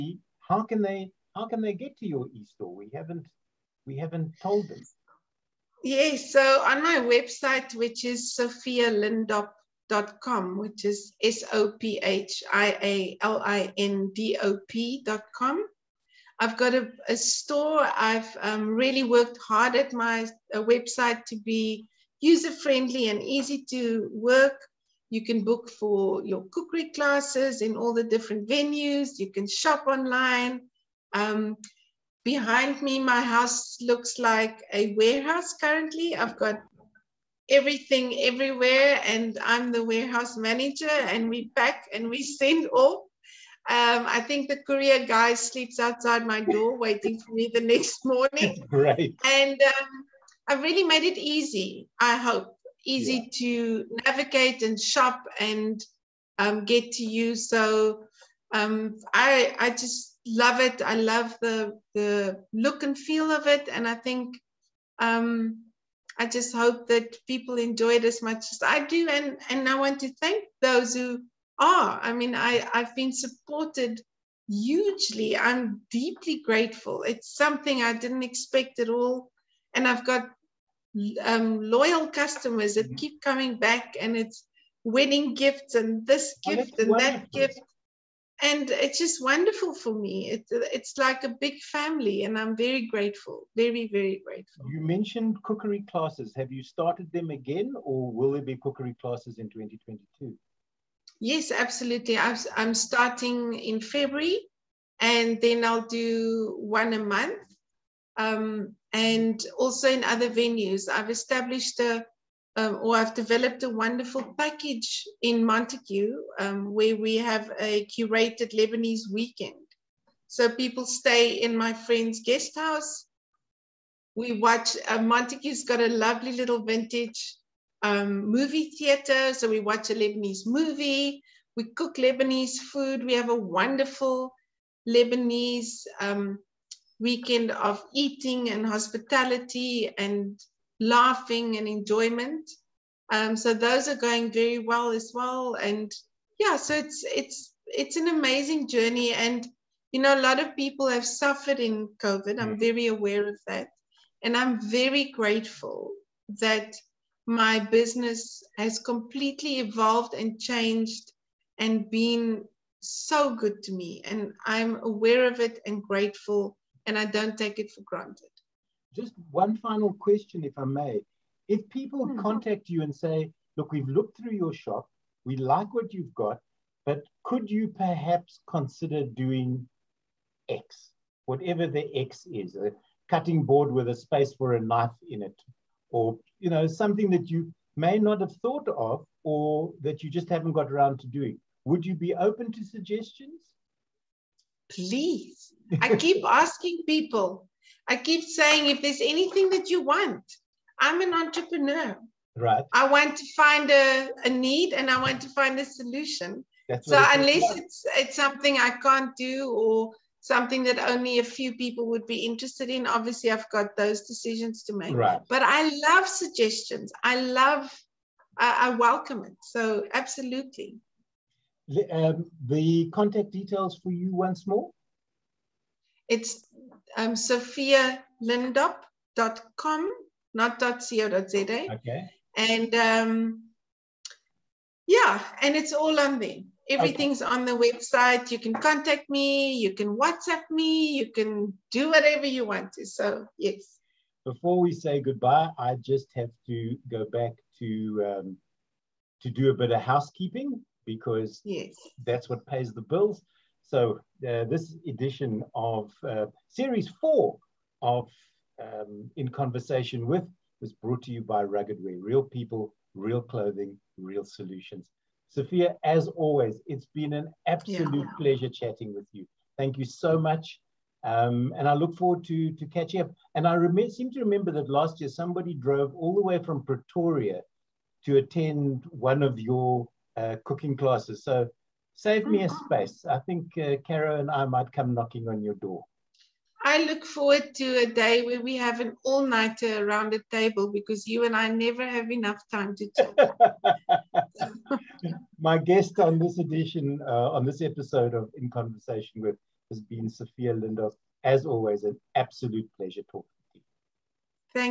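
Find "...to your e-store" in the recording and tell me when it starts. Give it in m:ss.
0:01.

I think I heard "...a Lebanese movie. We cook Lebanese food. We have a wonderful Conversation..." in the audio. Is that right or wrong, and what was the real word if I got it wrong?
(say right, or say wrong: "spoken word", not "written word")
wrong: "Lebanese", not "Conversation".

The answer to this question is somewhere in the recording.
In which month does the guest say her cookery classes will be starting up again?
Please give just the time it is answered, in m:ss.
1:43.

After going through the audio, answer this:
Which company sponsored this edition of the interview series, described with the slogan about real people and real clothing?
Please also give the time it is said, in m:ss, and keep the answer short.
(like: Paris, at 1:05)
Rugged Wear, at 4:21.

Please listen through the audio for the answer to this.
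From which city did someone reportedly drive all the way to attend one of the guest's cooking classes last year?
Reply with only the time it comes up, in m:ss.
4:36.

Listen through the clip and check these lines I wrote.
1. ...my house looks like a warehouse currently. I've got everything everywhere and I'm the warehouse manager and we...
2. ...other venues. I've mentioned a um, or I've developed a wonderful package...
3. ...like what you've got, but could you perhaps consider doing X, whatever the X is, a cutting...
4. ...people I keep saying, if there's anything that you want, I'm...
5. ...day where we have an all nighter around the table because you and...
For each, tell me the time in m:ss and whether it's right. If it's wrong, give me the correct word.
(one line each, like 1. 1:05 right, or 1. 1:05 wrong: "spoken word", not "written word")
1. 0:32 right
2. 1:50 wrong: "established", not "mentioned"
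3. 2:55 right
4. 3:16 right
5. 4:47 right.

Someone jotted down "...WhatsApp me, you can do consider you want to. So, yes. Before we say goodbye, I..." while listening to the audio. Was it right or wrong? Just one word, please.
wrong.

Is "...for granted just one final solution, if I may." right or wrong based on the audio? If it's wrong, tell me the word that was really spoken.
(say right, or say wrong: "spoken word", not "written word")
wrong: "question", not "solution".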